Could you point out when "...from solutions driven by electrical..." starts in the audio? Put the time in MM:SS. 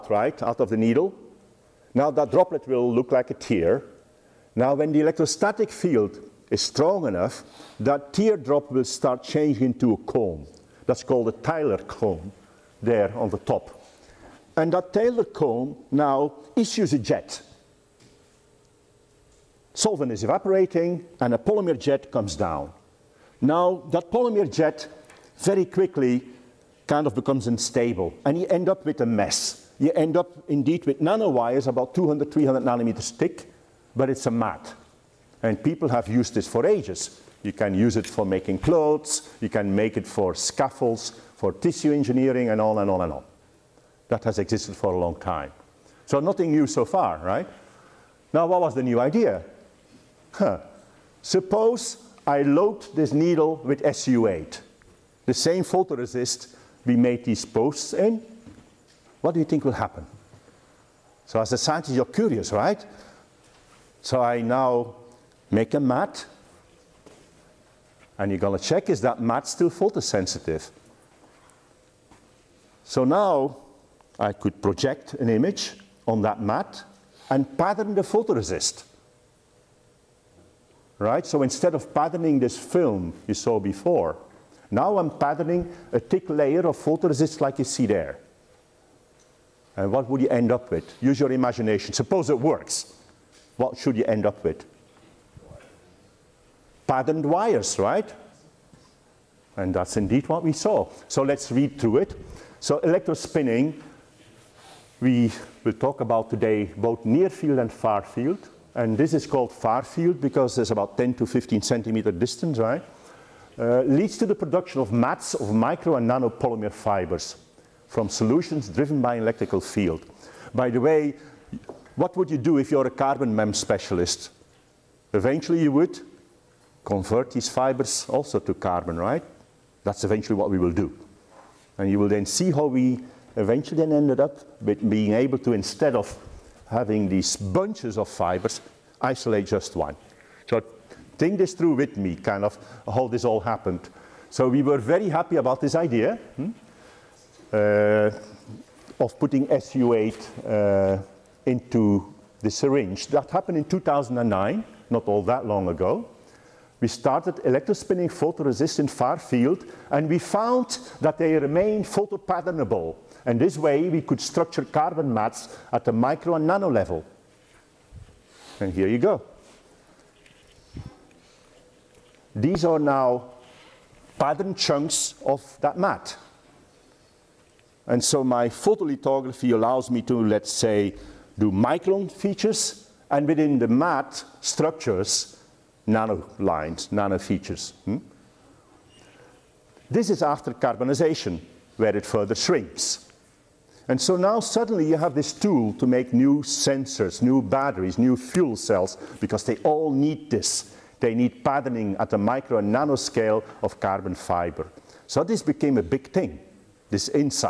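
01:57.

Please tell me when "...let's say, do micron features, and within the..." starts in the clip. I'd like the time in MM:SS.
03:00.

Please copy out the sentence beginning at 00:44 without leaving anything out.
That has existed for a long time.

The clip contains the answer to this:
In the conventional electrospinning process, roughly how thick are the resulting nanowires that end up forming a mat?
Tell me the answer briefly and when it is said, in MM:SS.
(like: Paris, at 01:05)
200 to 300 nanometers, at 00:31.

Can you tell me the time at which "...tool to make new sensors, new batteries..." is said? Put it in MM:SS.
03:15.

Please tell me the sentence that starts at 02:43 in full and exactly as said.
And this way, we could structure carbon mats at the micro and nano level.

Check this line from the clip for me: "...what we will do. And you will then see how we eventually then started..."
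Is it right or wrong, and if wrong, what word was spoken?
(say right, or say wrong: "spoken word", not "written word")
wrong: "ended", not "started".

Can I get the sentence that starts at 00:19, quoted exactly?
Solvent is evaporating and a polymer jet comes down.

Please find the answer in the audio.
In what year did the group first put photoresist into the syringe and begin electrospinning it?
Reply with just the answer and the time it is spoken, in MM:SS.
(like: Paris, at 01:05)
2009, at 02:33.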